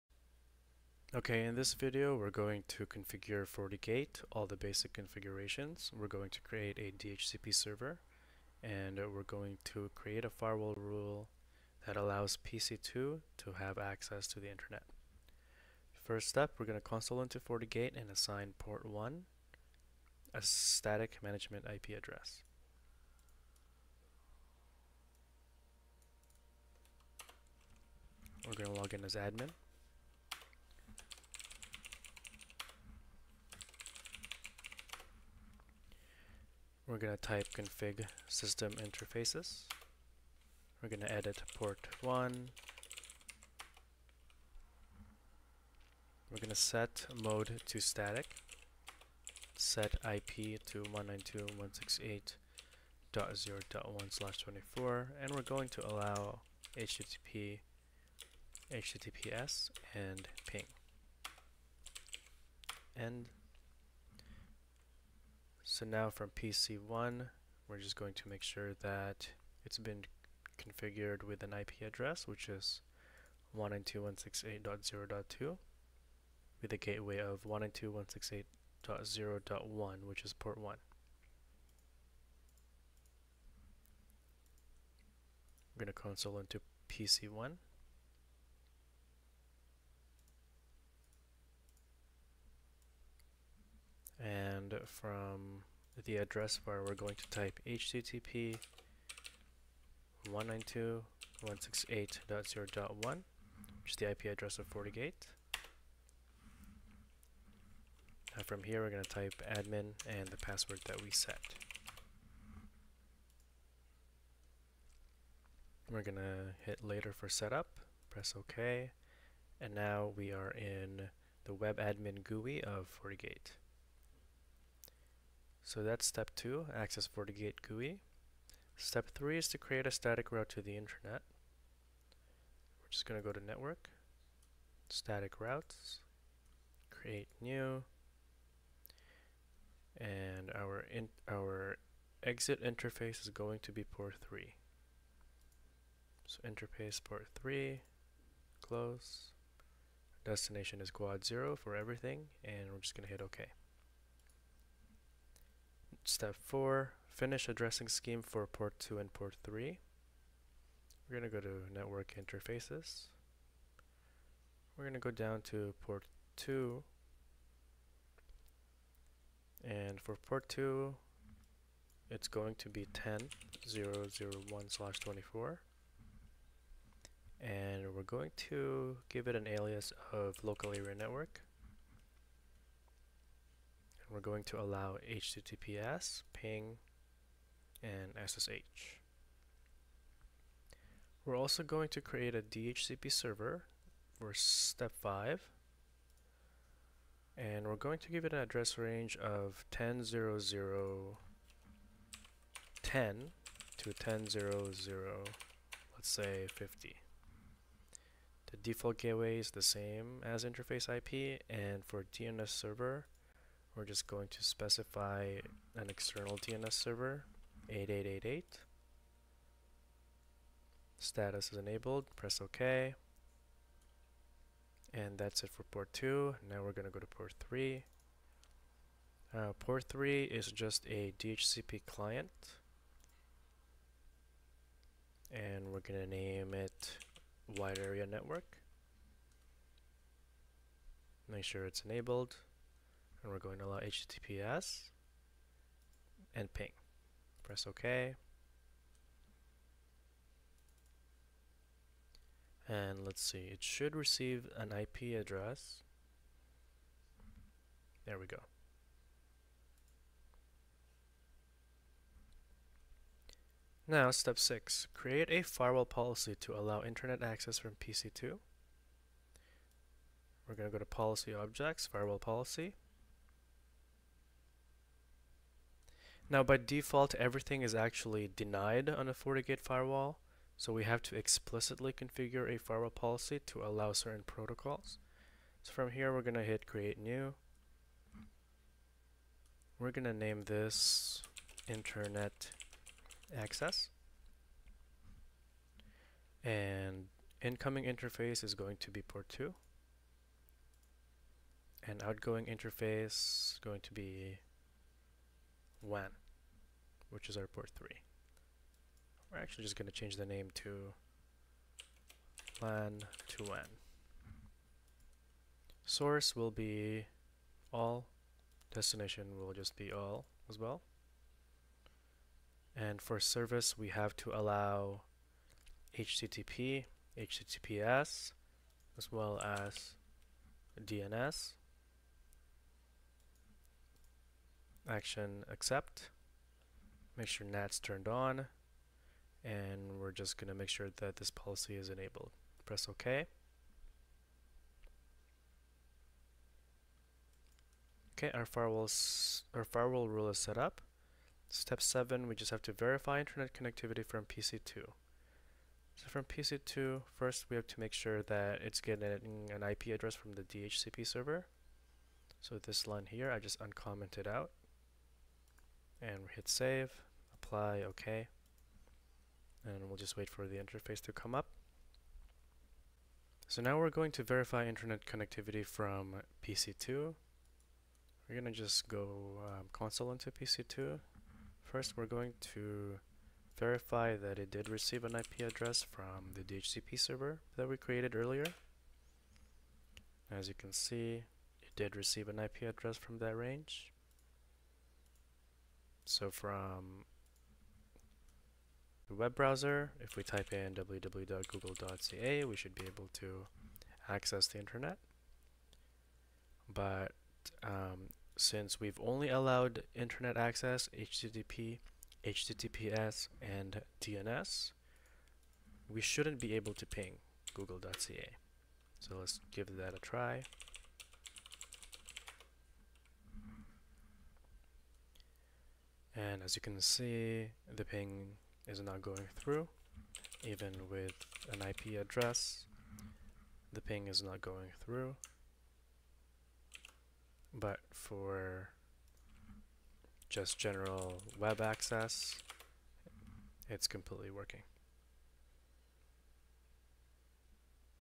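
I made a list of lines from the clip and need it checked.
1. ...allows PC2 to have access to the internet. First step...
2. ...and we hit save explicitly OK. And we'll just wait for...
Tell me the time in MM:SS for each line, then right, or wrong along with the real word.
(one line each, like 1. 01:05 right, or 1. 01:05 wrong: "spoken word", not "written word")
1. 00:11 right
2. 06:06 wrong: "apply", not "explicitly".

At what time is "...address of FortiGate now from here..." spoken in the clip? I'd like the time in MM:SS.
01:44.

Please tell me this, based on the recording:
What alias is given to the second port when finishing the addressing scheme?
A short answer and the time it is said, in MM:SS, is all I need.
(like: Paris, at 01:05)
local area network, at 03:00.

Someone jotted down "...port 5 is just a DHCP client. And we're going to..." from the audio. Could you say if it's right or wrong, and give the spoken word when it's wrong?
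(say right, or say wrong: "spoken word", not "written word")
wrong: "3", not "5".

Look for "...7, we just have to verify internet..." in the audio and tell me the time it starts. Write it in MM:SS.
05:51.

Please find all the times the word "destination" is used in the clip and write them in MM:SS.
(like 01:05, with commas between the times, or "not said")
02:30, 05:18.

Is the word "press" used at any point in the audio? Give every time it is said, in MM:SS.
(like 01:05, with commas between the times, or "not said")
01:58, 03:42, 04:07, 05:42.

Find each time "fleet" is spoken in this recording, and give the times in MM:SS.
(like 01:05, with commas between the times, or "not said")
not said.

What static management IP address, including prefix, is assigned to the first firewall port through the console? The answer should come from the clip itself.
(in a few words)
192.168.0.1/24.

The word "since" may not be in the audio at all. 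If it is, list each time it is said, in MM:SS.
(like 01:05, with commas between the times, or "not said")
06:48.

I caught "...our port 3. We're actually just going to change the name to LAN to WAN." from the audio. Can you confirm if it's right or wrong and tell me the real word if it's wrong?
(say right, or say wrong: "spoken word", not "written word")
right.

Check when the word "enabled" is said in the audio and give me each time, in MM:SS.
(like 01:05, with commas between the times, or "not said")
03:41, 04:01, 05:41.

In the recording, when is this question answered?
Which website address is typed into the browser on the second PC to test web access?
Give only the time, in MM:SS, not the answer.
06:40.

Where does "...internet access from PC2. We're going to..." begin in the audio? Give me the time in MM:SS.
04:26.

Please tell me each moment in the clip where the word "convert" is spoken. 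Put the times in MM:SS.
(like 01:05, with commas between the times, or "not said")
not said.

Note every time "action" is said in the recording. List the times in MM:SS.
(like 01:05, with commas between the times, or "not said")
05:34.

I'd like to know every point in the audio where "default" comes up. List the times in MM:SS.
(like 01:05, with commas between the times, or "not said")
03:28, 04:36.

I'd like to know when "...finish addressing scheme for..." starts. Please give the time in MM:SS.
02:37.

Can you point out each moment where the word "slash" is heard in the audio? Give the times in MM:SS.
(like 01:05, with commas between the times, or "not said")
00:54, 02:54.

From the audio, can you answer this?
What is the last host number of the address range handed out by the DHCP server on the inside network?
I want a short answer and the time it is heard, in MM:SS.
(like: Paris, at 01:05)
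50, at 03:26.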